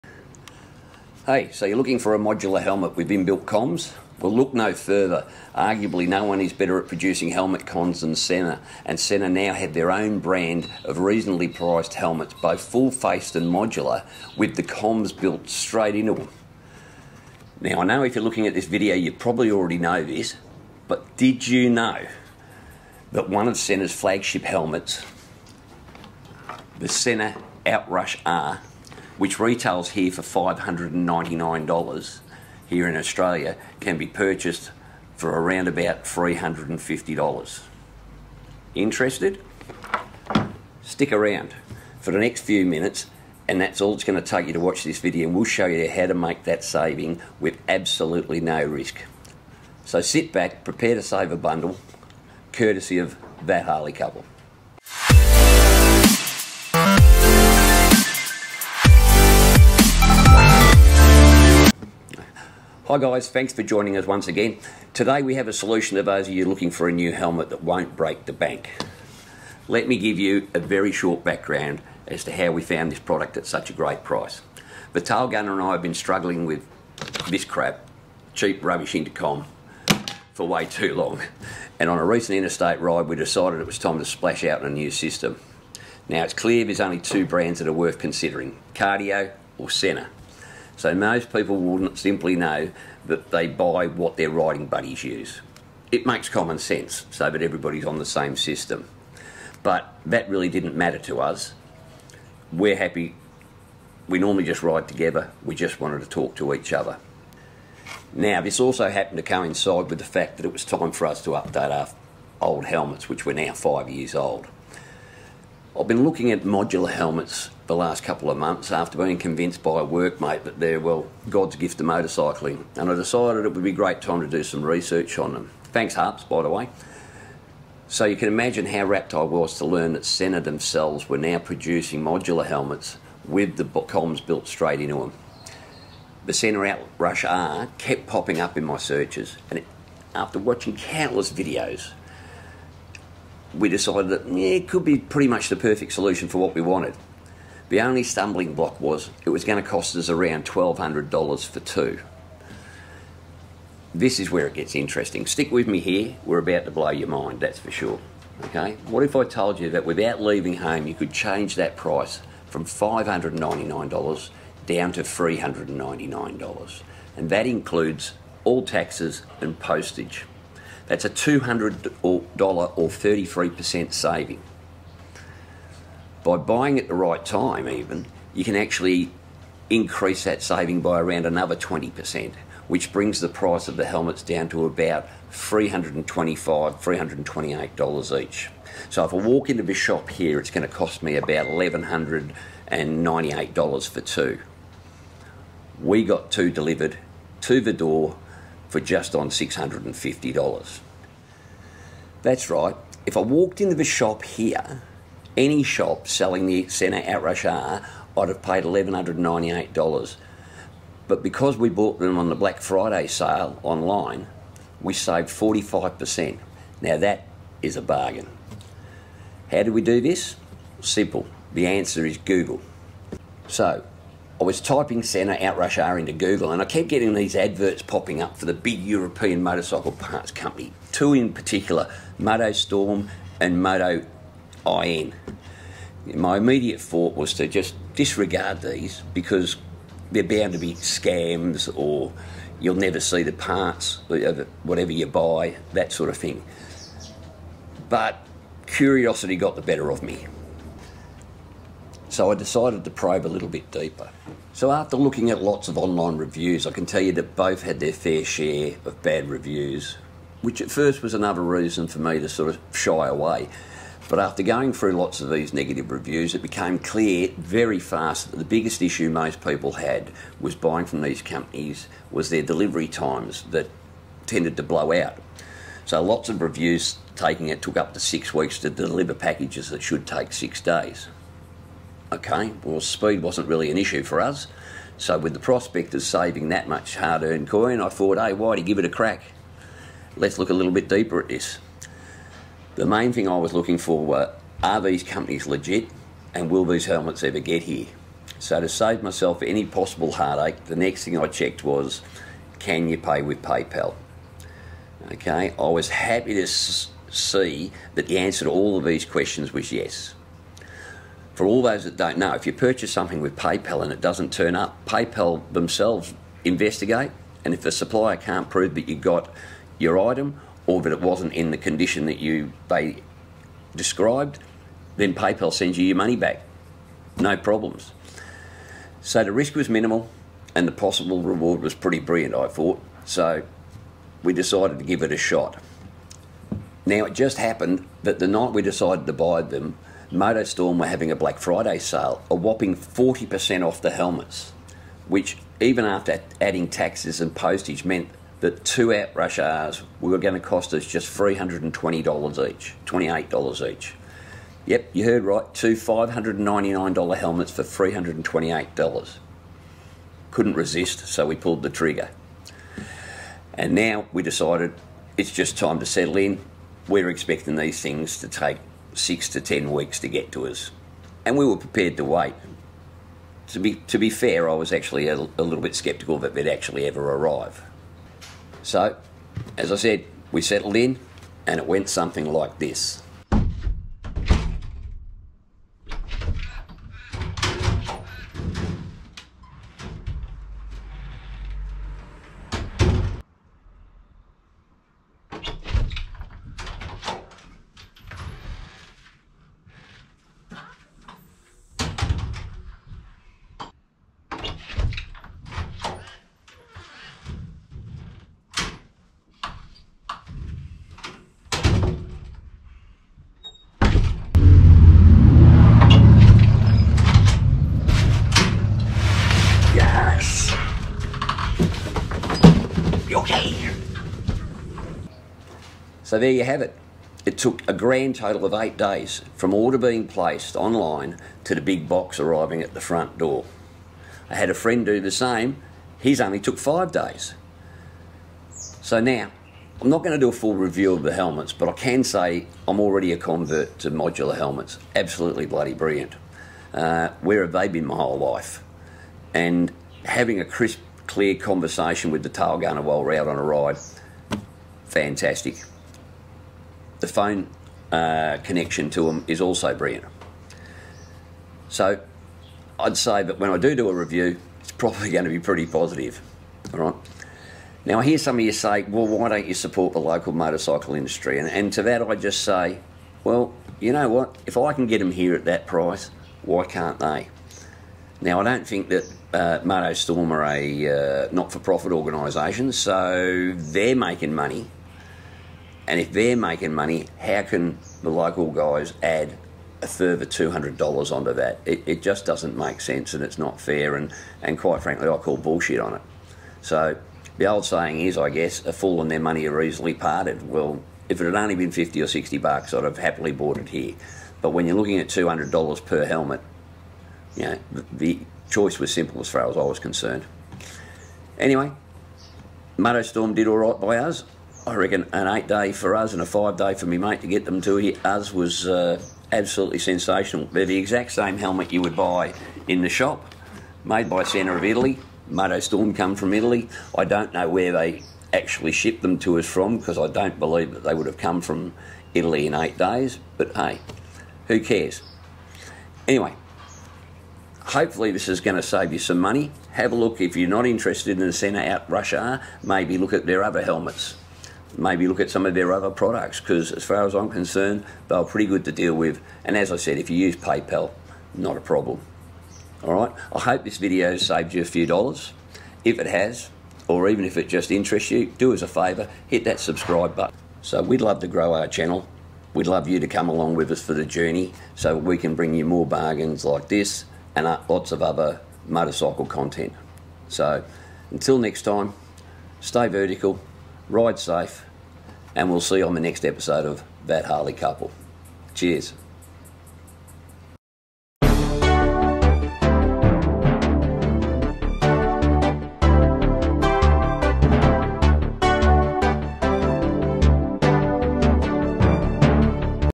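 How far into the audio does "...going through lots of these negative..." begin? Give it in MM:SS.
04:24.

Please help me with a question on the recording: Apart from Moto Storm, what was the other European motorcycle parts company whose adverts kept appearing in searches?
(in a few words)
Moto IN.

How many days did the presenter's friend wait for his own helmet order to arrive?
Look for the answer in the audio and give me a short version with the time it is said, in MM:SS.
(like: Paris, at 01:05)
5 days, at 07:16.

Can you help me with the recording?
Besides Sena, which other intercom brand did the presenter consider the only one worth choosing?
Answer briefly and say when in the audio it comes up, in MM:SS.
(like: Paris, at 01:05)
Cardio, at 01:28.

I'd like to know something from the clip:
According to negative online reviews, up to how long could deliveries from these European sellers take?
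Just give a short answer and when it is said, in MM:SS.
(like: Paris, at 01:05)
6 weeks, at 04:38.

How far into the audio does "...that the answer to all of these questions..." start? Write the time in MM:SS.
05:07.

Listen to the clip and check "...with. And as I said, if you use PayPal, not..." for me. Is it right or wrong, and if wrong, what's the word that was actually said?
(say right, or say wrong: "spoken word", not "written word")
right.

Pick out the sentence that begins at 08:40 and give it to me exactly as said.
They're the exact same helmet you would buy in the shop, made by Centre of Italy.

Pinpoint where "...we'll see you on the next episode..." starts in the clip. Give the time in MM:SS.
09:35.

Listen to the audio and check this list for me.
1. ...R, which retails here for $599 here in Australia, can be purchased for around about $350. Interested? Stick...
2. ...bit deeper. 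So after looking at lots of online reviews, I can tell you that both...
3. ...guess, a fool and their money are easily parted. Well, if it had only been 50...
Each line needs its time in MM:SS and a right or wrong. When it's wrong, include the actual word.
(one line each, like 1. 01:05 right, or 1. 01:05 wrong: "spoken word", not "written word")
1. 00:28 right
2. 04:13 right
3. 08:18 right.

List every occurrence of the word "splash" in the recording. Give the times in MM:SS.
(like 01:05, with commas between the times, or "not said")
01:24.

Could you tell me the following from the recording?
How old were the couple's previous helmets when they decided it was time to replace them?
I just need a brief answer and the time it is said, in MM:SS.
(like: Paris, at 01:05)
5 years, at 01:53.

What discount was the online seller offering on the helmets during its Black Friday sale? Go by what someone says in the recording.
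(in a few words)
40%.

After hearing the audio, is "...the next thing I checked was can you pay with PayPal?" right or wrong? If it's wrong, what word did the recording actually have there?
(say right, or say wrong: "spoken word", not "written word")
right.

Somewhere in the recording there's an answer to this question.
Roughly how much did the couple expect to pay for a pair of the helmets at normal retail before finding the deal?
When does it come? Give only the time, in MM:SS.
02:30.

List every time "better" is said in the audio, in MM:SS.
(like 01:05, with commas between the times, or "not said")
00:06, 04:09.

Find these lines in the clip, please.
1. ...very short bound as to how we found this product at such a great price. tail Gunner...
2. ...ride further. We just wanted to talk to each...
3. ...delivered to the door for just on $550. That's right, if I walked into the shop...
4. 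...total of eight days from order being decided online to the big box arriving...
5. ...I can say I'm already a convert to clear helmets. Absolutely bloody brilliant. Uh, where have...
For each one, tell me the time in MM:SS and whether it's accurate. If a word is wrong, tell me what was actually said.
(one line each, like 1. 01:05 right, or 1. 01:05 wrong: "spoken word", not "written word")
1. 01:10 wrong: "background", not "bound"
2. 01:44 wrong: "together", not "further"
3. 03:16 wrong: "650", not "550"
4. 07:08 wrong: "placed", not "decided"
5. 07:21 wrong: "modular", not "clear".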